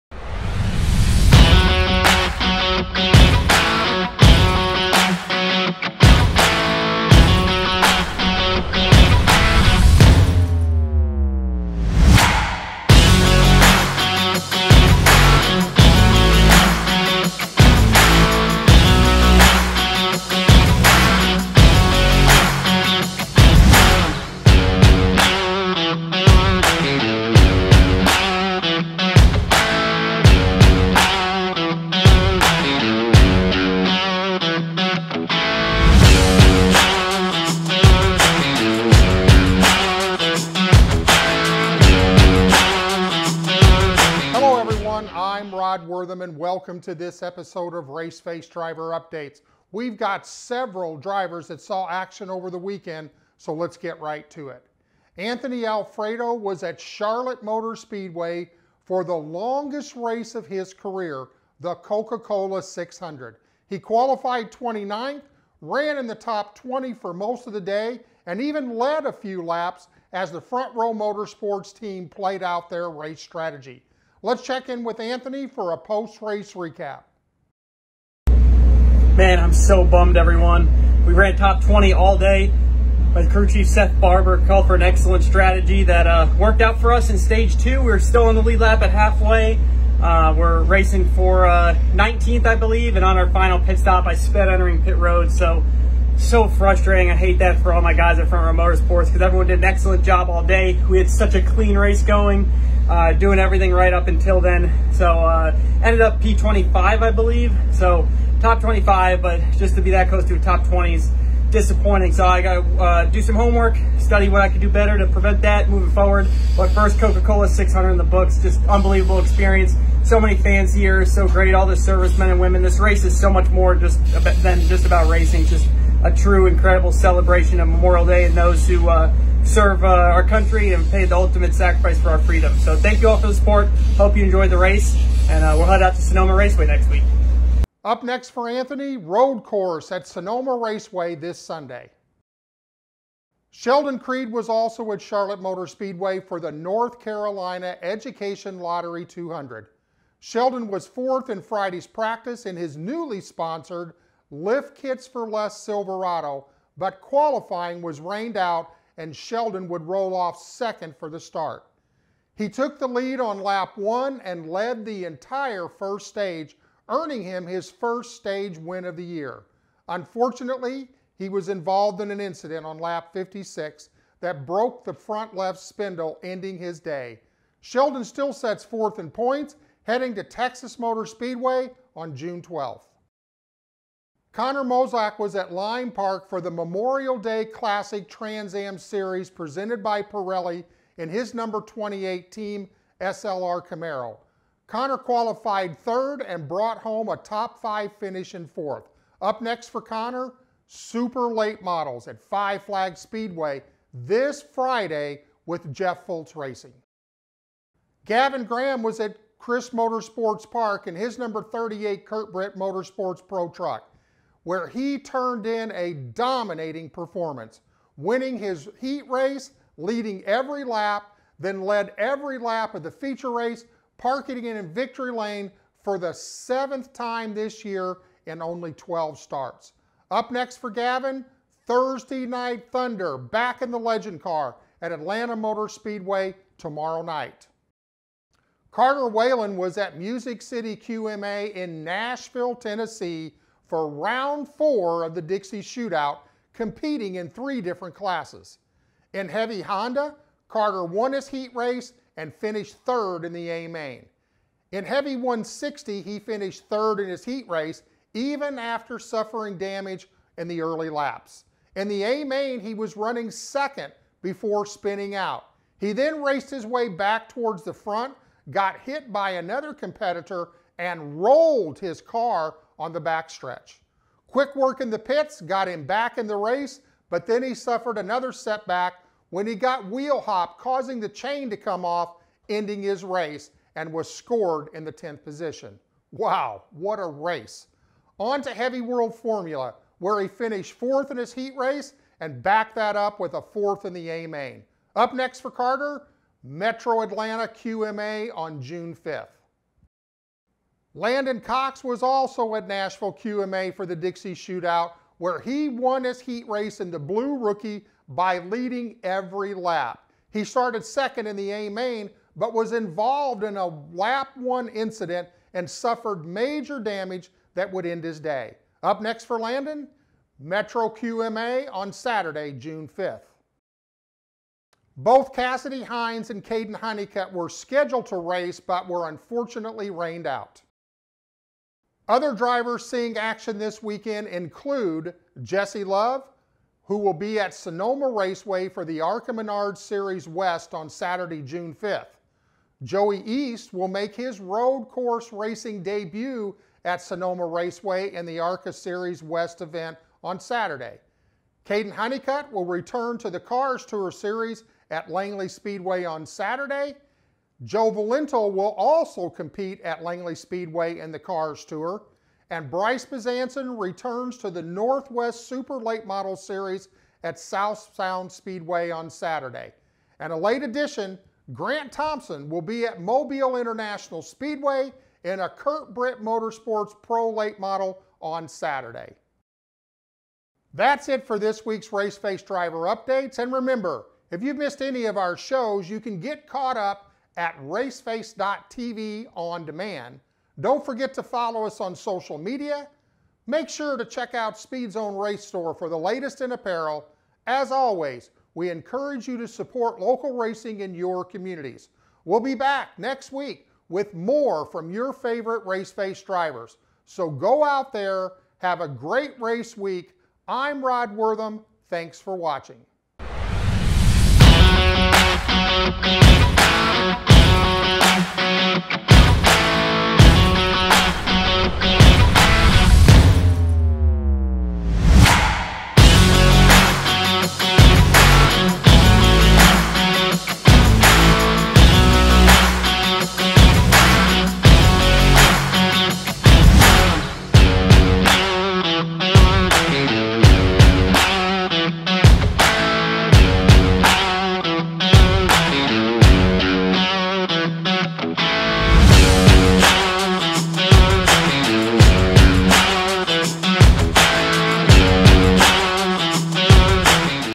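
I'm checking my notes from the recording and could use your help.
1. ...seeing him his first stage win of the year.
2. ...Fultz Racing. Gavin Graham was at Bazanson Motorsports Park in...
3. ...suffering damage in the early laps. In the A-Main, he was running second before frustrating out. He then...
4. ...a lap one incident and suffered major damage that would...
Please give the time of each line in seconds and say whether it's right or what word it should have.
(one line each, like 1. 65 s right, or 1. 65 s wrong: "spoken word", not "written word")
1. 166 s wrong: "earning", not "seeing"
2. 206 s wrong: "Chris", not "Bazanson"
3. 258 s wrong: "spinning", not "frustrating"
4. 313 s right.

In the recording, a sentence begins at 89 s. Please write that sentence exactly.
Uh, we're racing for uh, 19th, I believe, and on our final pit stop, I sped entering pit road, so so frustrating.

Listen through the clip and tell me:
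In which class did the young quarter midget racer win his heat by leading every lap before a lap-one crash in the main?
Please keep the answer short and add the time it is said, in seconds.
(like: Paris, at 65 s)
Blue rookie, at 306 s.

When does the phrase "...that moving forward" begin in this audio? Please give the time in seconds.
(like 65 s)
115 s.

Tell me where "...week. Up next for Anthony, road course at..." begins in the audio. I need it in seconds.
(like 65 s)
136 s.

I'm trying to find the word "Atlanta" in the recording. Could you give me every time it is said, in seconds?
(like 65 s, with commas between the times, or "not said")
234 s, 297 s.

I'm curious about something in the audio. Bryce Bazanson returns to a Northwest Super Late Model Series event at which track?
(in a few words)
South Sound Speedway.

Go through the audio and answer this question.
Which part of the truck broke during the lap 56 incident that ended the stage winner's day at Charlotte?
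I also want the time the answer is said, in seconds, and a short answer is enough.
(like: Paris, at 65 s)
Front left spindle, at 174 s.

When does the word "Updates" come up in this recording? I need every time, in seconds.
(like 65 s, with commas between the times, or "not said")
48 s, 382 s.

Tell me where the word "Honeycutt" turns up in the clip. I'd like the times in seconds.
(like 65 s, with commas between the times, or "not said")
326 s, 351 s.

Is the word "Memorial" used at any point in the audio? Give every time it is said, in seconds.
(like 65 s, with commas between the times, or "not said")
127 s, 186 s.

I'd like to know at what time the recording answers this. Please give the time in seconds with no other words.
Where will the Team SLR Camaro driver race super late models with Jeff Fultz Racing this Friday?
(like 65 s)
202 s.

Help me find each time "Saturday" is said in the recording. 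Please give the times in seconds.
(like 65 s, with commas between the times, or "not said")
321 s, 340 s, 350 s, 356 s, 369 s, 378 s.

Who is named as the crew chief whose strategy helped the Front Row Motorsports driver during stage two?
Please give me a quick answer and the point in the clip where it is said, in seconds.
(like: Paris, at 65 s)
Seth Barbour, at 83 s.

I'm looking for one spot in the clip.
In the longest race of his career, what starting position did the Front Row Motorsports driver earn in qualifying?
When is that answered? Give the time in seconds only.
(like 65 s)
64 s.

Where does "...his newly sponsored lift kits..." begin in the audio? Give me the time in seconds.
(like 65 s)
152 s.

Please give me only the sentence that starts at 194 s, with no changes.
Connor qualified third and brought home a top five finish in fourth.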